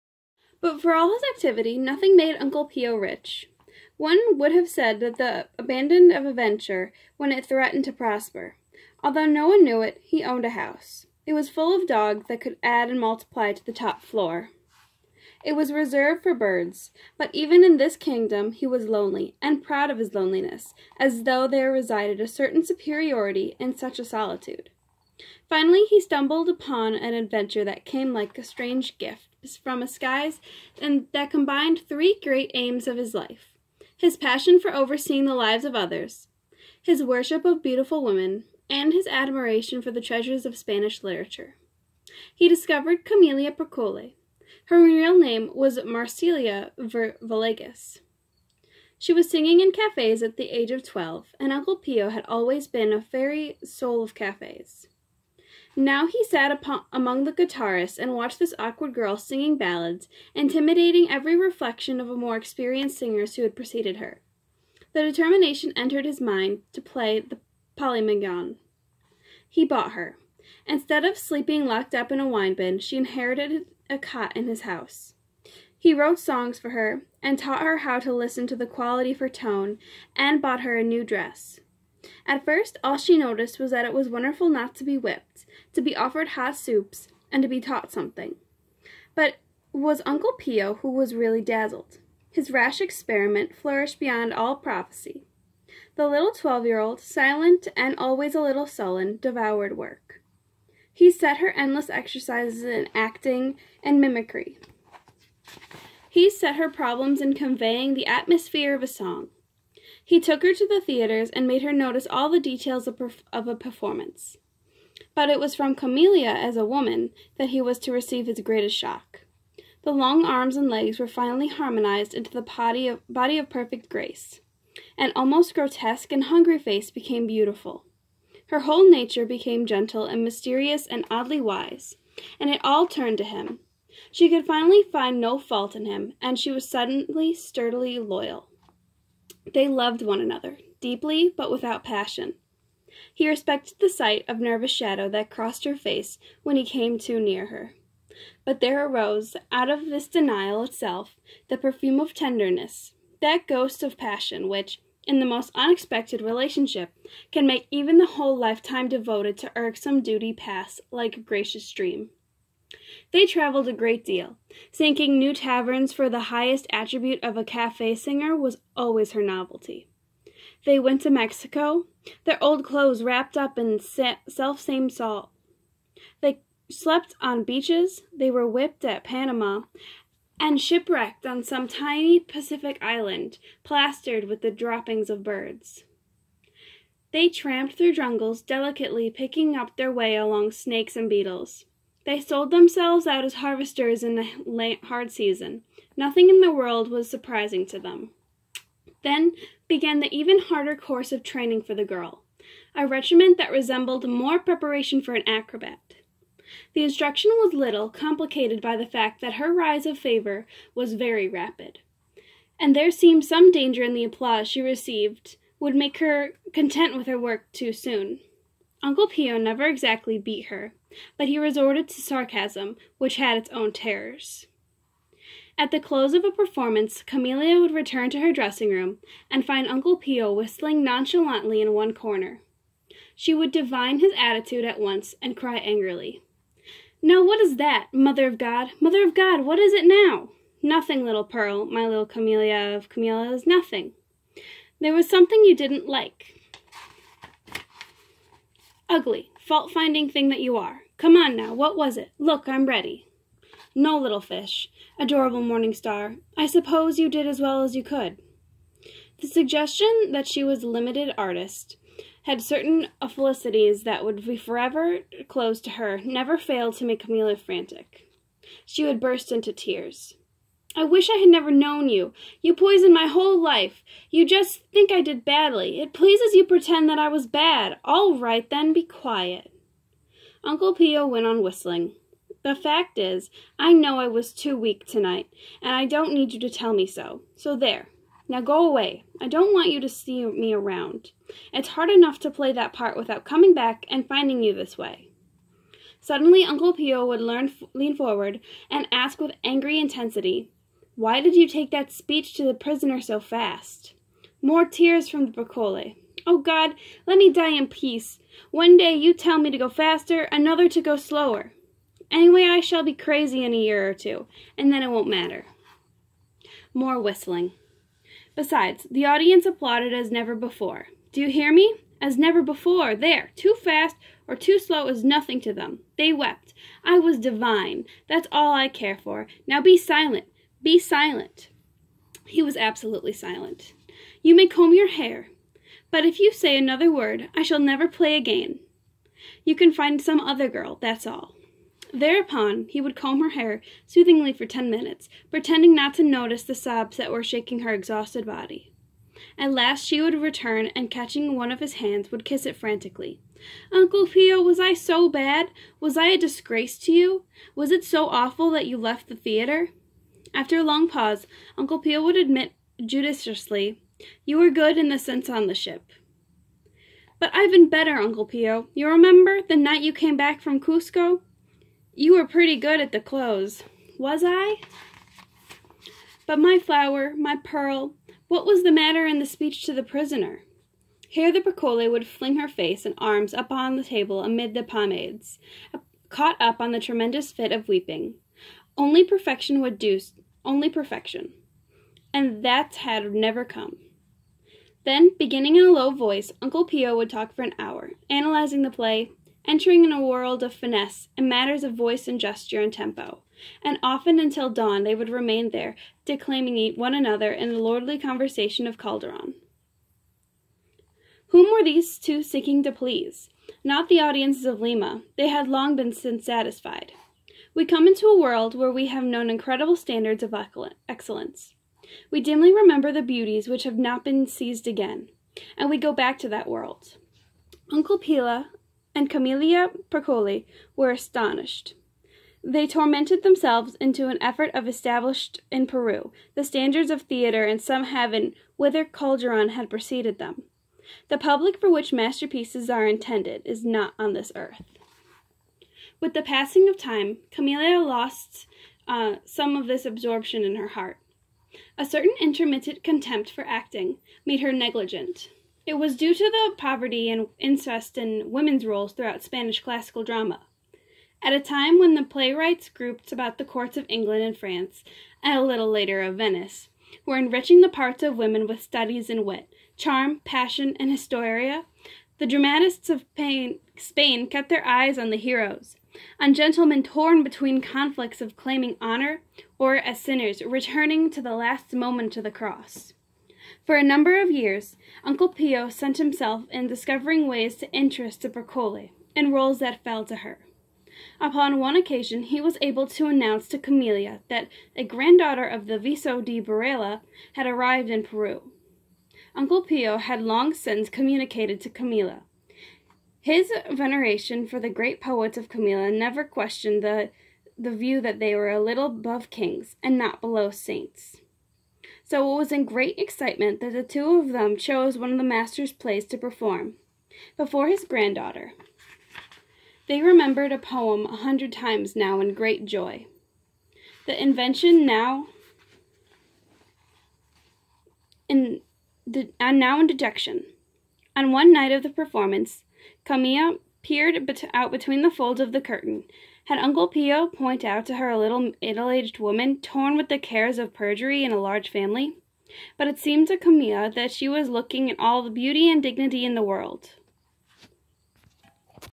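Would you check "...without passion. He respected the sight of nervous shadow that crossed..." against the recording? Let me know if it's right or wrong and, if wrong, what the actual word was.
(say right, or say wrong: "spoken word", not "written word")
right.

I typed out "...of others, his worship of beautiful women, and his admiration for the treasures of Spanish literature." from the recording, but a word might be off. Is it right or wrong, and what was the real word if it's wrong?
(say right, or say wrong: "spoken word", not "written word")
right.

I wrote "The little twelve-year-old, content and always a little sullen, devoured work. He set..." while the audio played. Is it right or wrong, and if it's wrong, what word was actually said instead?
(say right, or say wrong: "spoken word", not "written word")
wrong: "silent", not "content".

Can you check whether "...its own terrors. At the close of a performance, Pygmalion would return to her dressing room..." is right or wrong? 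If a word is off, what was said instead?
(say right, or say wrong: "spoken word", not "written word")
wrong: "Camelia", not "Pygmalion".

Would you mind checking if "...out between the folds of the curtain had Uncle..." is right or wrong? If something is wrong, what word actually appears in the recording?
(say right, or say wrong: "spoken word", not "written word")
right.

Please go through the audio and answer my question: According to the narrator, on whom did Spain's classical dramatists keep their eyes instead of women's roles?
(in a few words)
The heroes.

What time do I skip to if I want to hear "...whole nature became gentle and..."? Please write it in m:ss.
2:08.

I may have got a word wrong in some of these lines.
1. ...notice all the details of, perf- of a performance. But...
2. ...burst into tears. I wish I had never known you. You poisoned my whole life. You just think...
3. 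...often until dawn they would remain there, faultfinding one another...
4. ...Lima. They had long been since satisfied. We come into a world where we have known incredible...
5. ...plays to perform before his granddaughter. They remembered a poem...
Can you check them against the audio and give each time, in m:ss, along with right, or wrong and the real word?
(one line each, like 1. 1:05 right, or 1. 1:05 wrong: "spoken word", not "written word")
1. 1:51 right
2. 4:28 right
3. 6:43 wrong: "declaiming", not "faultfinding"
4. 6:54 right
5. 8:35 right.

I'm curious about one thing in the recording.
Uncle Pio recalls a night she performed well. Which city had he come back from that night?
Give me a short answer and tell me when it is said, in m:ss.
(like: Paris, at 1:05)
Cusco, at 6:10.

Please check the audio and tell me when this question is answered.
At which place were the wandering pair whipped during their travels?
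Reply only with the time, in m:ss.
2:59.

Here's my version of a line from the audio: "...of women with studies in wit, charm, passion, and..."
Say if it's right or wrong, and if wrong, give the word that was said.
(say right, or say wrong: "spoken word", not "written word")
right.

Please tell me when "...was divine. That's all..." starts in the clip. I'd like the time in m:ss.
5:26.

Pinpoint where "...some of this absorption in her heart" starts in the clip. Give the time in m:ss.
7:29.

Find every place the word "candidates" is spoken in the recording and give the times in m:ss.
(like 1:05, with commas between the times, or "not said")
not said.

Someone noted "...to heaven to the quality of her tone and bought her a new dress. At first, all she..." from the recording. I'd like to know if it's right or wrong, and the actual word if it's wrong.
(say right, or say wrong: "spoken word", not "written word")
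wrong: "listen", not "heaven".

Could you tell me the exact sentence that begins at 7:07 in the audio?
Uncle Pio and Camilla Perichole were astonished.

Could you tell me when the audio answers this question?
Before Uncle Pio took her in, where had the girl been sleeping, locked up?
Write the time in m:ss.
1:12.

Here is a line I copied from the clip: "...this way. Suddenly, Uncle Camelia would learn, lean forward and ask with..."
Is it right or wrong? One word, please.
wrong.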